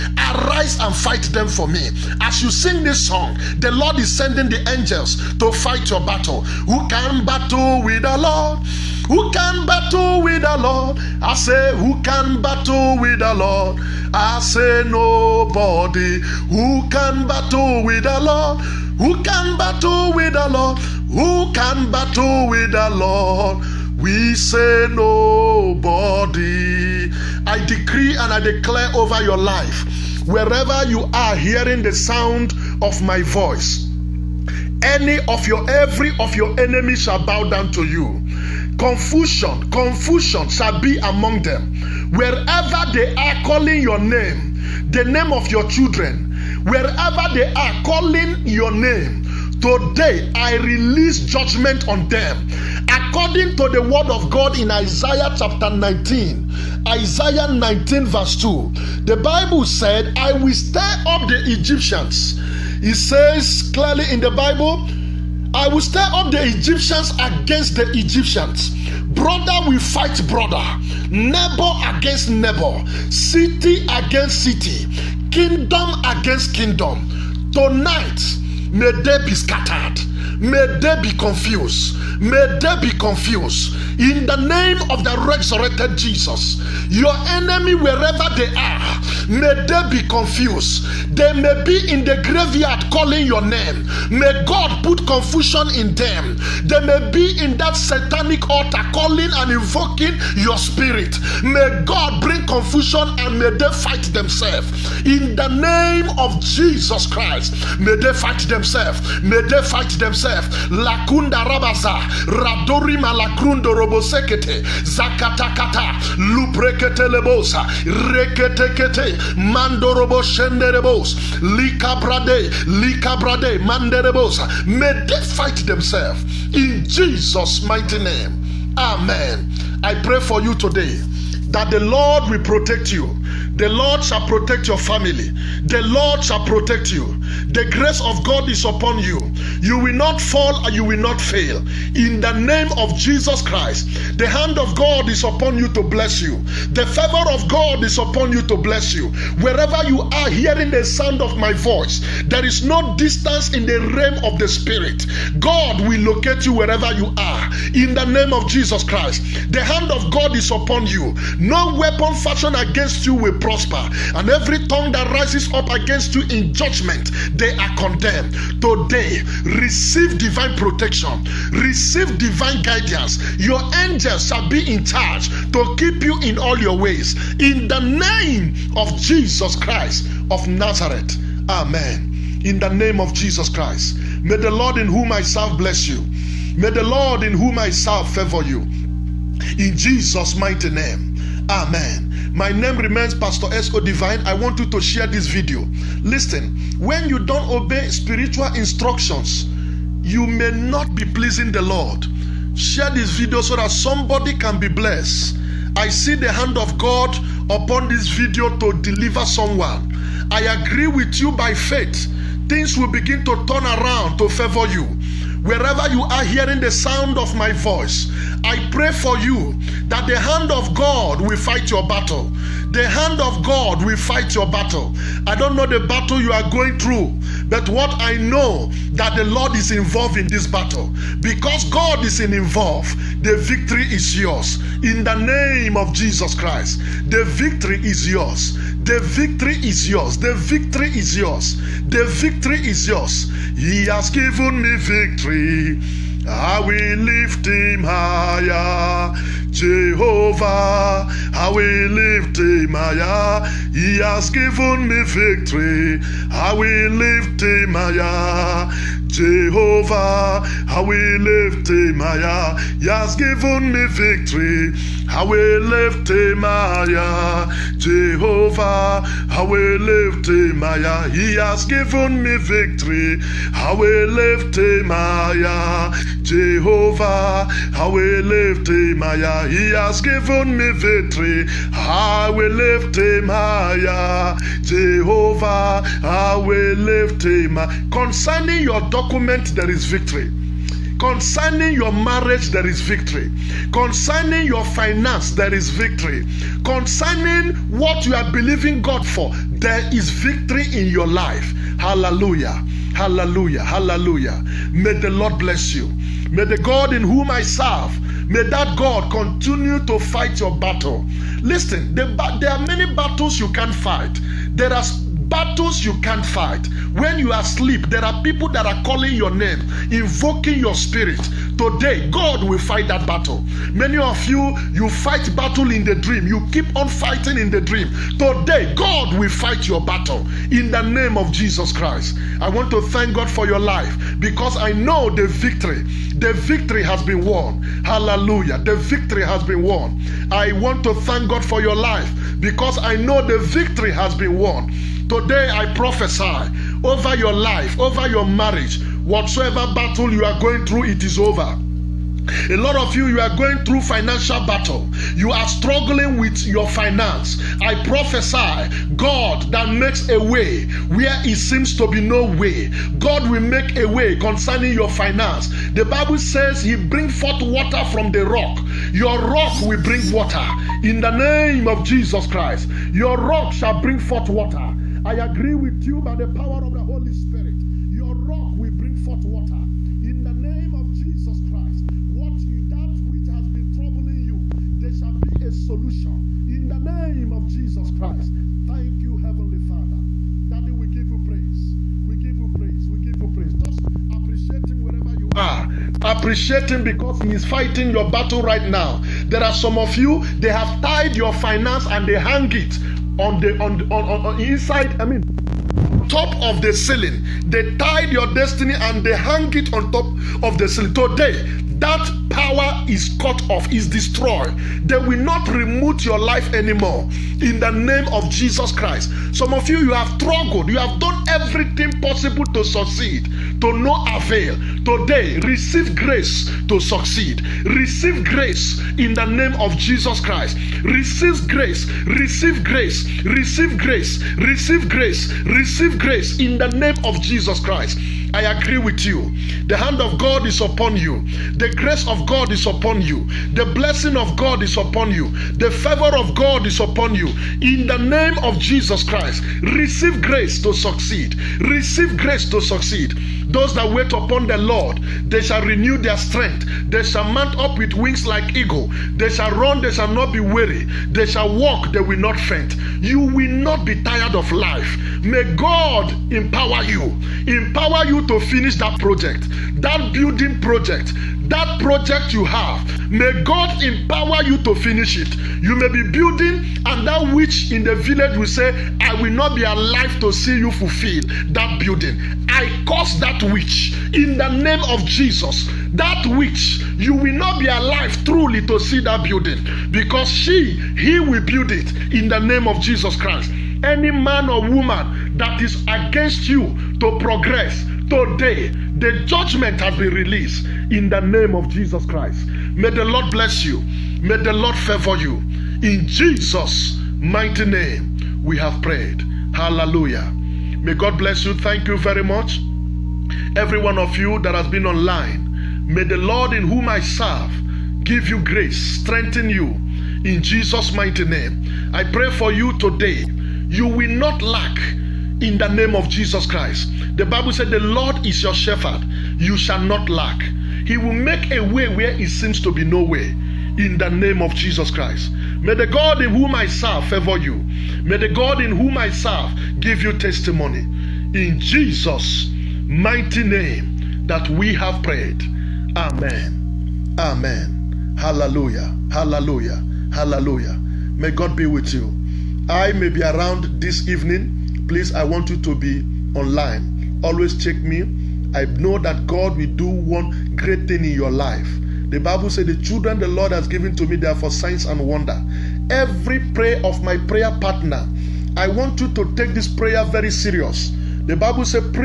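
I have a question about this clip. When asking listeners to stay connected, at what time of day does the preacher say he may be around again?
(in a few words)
This evening.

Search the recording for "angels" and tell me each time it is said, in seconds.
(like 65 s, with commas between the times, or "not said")
4 s, 173 s.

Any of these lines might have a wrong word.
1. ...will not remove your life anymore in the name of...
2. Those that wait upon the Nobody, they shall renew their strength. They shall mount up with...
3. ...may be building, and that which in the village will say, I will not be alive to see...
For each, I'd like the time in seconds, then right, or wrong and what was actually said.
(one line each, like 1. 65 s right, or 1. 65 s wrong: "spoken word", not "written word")
1. 414 s right
2. 453 s wrong: "Lord", not "Nobody"
3. 475 s right.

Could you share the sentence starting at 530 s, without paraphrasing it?
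He will make a way where it seems to be no way.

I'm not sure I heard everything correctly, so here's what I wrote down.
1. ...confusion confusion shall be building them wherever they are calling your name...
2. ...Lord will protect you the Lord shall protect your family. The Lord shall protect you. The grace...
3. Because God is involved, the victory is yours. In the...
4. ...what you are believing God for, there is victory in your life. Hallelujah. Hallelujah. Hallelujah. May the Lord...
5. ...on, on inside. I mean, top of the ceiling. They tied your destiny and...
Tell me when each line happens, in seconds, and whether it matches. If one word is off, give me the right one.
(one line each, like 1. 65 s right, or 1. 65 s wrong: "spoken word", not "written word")
1. 38 s wrong: "among", not "building"
2. 131 s right
3. 231 s right
4. 297 s right
5. 404 s right.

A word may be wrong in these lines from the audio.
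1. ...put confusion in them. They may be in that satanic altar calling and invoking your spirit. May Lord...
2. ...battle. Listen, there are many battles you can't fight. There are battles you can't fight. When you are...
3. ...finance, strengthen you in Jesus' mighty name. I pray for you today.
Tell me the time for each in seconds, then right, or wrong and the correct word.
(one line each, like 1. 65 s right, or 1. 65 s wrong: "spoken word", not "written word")
1. 94 s wrong: "God", not "Lord"
2. 310 s right
3. 518 s wrong: "grace", not "finance".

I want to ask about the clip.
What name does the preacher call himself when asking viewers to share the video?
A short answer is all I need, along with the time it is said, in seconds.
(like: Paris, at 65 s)
Pastor S.O. Divine, at 193 s.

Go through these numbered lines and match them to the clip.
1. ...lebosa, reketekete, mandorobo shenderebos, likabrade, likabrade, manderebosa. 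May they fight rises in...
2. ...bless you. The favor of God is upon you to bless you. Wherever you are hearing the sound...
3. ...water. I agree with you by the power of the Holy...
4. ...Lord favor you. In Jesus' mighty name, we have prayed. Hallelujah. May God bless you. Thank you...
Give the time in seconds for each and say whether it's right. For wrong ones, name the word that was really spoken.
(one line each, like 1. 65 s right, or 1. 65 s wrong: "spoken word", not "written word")
1. 117 s wrong: "themselves", not "rises"
2. 145 s right
3. 374 s right
4. 504 s right.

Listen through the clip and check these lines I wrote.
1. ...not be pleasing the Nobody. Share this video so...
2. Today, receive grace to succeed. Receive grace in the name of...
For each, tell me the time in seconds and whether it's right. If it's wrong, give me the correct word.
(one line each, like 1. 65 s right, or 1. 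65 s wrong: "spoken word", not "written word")
1. 200 s wrong: "Lord", not "Nobody"
2. 424 s right.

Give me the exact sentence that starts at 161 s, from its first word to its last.
No weapon fashioned against you will prosper, and every tongue that rises up against you in judgment, they are condemned.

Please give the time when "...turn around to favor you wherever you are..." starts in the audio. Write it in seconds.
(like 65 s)
213 s.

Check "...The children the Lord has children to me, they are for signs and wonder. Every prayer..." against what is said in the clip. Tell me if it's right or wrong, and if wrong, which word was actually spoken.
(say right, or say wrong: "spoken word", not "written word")
wrong: "given", not "children".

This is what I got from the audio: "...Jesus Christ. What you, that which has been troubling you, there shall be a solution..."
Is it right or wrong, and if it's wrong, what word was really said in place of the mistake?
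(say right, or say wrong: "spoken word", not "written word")
right.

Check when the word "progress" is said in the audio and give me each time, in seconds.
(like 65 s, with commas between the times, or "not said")
497 s.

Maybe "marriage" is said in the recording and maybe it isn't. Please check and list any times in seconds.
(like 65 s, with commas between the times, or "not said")
291 s, 348 s.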